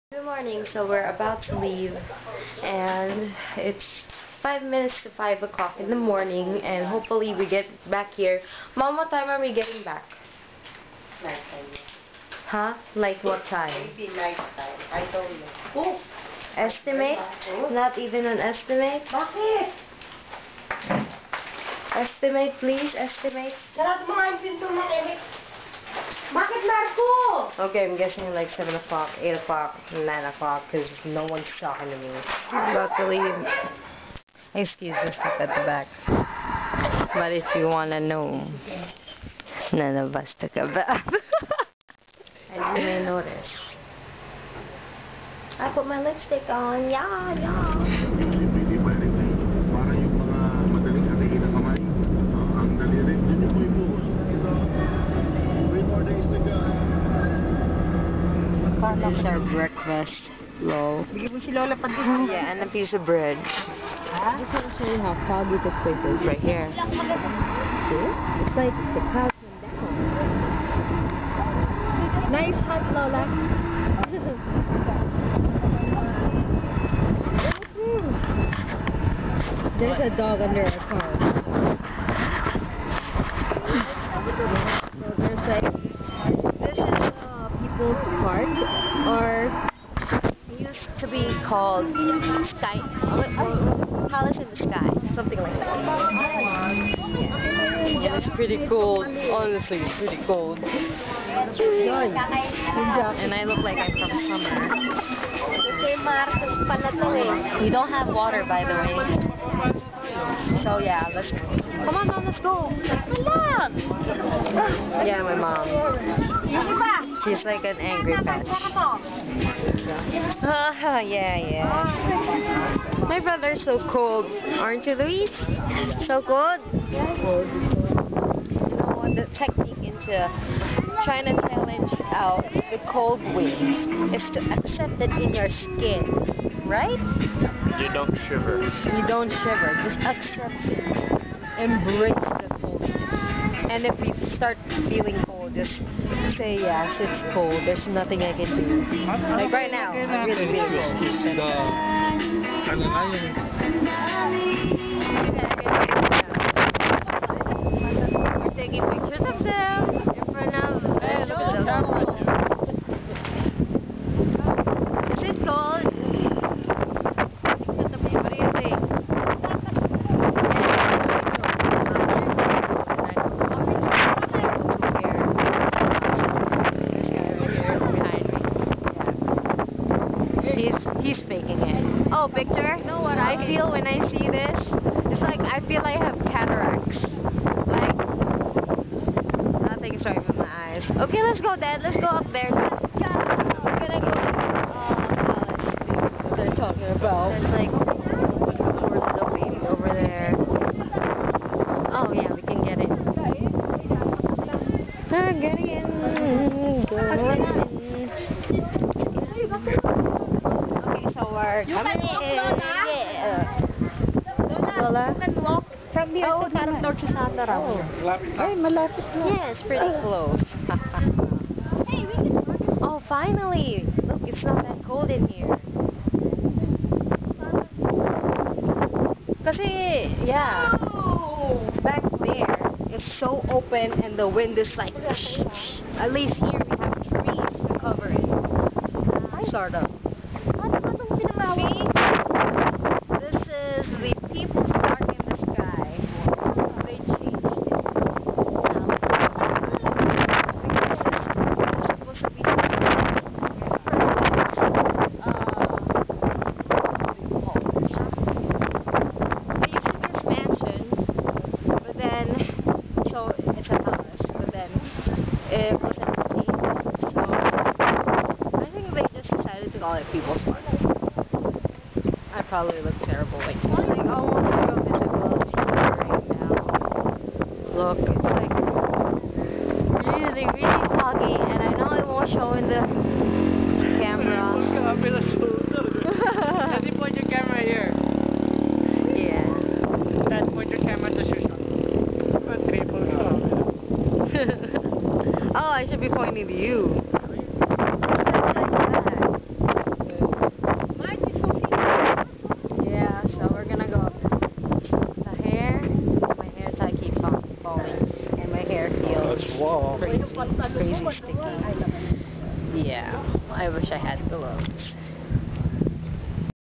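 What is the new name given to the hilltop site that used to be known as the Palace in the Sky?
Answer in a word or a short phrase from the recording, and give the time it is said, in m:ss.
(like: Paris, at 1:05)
People's Park in the Sky, at 4:04.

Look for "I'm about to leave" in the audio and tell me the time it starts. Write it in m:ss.
0:32.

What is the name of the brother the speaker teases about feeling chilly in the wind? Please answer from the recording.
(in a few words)
Luis.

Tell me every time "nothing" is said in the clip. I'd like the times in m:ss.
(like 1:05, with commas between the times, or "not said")
2:27, 3:09.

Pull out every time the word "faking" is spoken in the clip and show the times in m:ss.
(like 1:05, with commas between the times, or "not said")
3:01.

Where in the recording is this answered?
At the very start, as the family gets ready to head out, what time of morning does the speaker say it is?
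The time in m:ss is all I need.
0:04.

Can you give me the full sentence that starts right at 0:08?
Mom, what time are we getting back?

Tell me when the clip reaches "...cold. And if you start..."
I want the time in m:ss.
2:22.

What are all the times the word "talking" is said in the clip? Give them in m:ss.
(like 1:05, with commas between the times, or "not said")
0:31, 3:16.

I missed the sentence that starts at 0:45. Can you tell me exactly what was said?
I put my lipstick on, yeah, yeah.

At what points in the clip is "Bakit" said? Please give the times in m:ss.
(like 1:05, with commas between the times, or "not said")
0:19, 0:26.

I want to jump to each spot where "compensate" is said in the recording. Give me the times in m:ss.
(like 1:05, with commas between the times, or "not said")
not said.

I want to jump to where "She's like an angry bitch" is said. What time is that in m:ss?
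1:57.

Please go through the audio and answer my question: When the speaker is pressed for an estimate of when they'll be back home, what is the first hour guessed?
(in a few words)
7 o'clock.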